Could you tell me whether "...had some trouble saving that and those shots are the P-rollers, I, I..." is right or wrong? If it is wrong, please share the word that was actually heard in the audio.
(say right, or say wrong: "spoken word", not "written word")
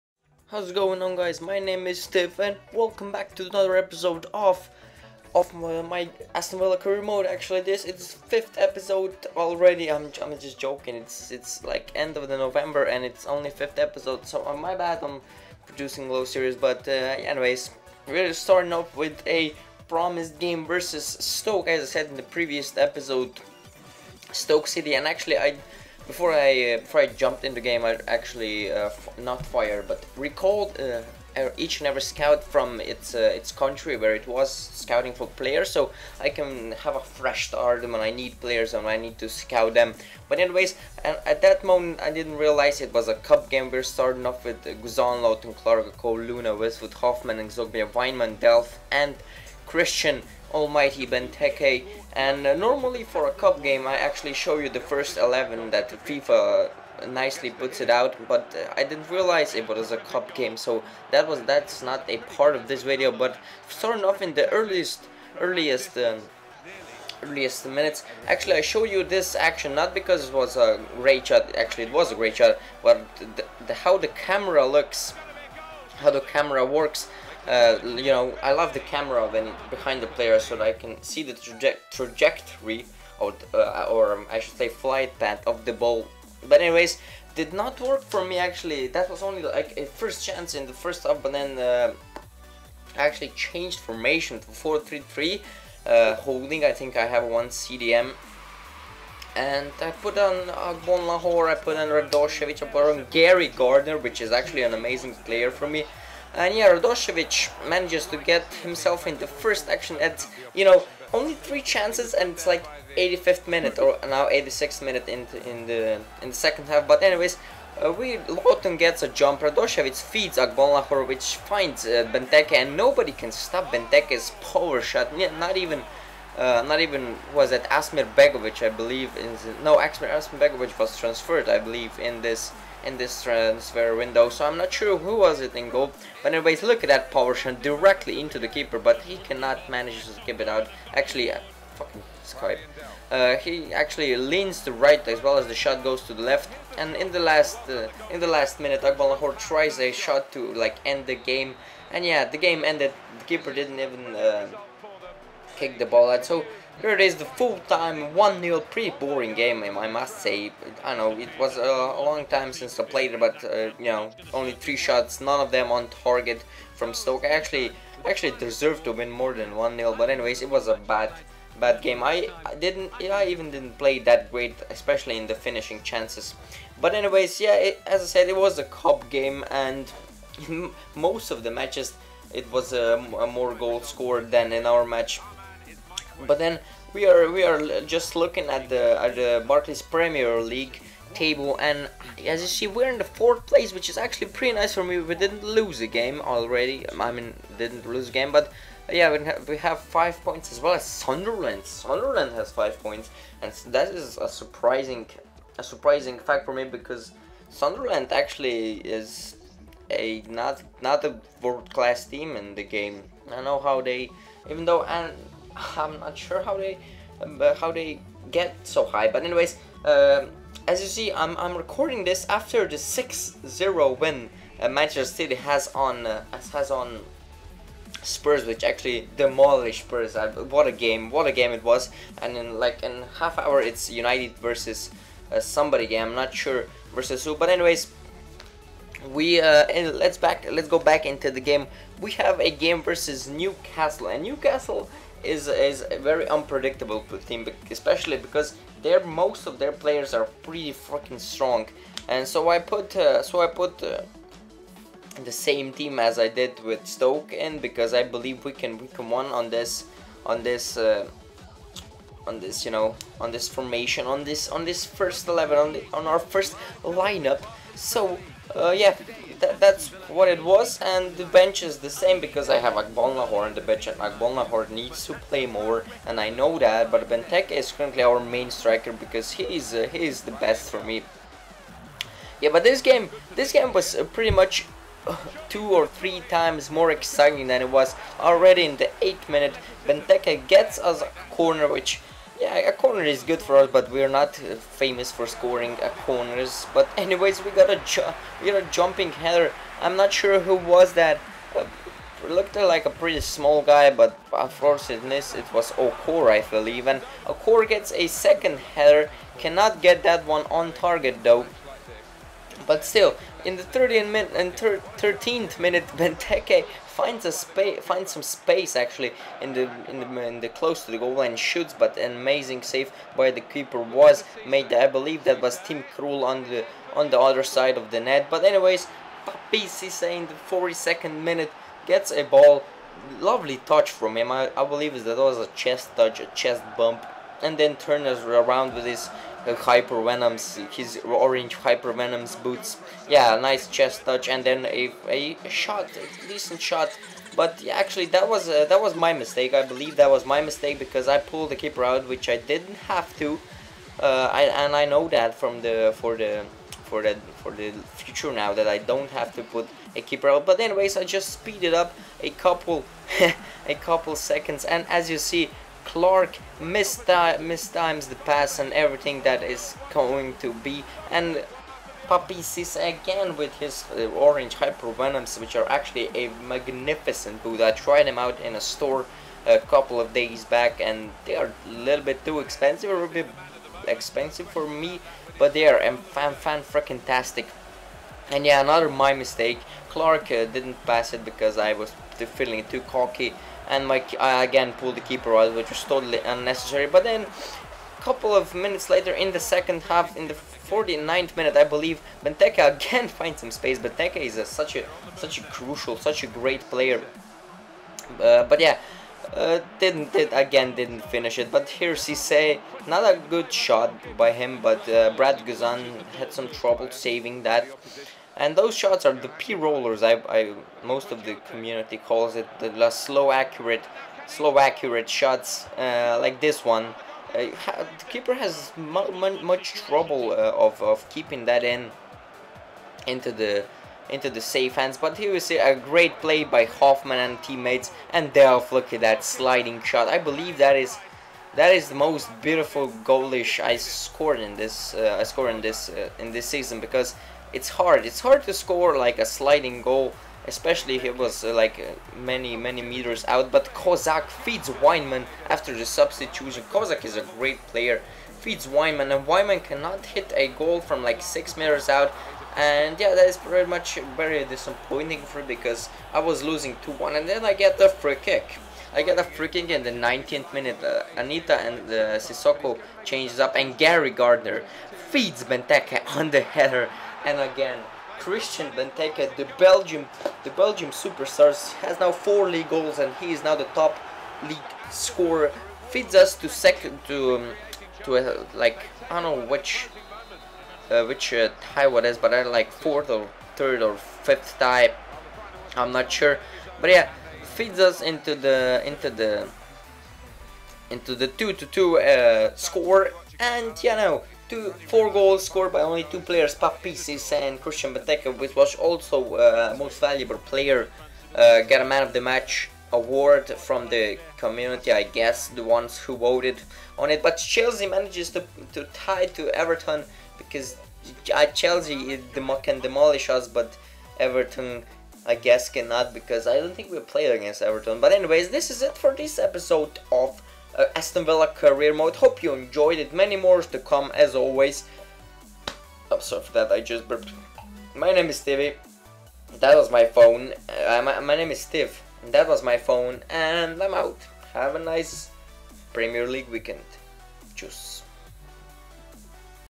right.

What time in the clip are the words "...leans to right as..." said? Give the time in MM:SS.
02:24.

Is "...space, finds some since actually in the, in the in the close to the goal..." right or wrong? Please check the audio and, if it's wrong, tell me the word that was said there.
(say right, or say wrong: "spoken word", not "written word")
wrong: "space", not "since".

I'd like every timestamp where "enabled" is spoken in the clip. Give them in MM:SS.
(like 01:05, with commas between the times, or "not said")
not said.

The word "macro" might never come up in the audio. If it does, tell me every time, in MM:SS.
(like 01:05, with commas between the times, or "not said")
not said.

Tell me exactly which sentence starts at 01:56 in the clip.
But anyways, uh, we Lowton gets a jump.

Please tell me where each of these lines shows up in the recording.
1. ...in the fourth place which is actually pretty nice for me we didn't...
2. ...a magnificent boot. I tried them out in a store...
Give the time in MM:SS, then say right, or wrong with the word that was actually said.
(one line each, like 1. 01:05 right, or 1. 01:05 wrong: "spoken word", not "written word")
1. 03:12 right
2. 06:16 right.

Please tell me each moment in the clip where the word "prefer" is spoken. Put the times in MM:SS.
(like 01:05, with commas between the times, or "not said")
not said.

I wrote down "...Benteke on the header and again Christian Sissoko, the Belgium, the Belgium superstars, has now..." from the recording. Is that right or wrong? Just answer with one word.
wrong.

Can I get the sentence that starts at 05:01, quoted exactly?
Uh, looked like a pretty small guy, but unfortunately it was Okore, I believe.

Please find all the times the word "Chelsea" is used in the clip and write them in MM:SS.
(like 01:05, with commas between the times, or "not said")
08:37, 08:41.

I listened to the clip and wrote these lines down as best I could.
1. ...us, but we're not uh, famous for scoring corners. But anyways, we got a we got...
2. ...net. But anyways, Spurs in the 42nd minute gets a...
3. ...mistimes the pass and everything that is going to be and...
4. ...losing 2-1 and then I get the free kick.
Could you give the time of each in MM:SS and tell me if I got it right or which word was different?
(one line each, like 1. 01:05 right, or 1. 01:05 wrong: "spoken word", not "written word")
1. 04:53 right
2. 05:27 wrong: "Papi", not "Spurs"
3. 06:06 right
4. 07:46 right.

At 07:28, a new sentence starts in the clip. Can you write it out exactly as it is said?
It's hard to score like a sliding goal, especially if it was uh, like uh, many many meters out.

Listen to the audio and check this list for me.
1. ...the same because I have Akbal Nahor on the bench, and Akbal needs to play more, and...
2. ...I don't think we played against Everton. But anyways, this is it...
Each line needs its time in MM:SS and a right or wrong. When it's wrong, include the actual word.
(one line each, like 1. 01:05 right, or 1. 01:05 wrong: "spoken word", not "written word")
1. 04:31 right
2. 08:46 right.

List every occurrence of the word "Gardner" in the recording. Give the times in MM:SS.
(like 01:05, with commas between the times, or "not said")
01:43, 07:54.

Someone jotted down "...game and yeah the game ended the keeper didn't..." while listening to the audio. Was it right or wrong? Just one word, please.
right.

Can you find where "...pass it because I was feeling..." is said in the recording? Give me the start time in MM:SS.
06:30.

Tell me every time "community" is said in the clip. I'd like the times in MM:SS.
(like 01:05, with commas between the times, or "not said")
07:01, 08:34.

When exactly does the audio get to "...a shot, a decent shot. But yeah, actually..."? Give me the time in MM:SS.
05:45.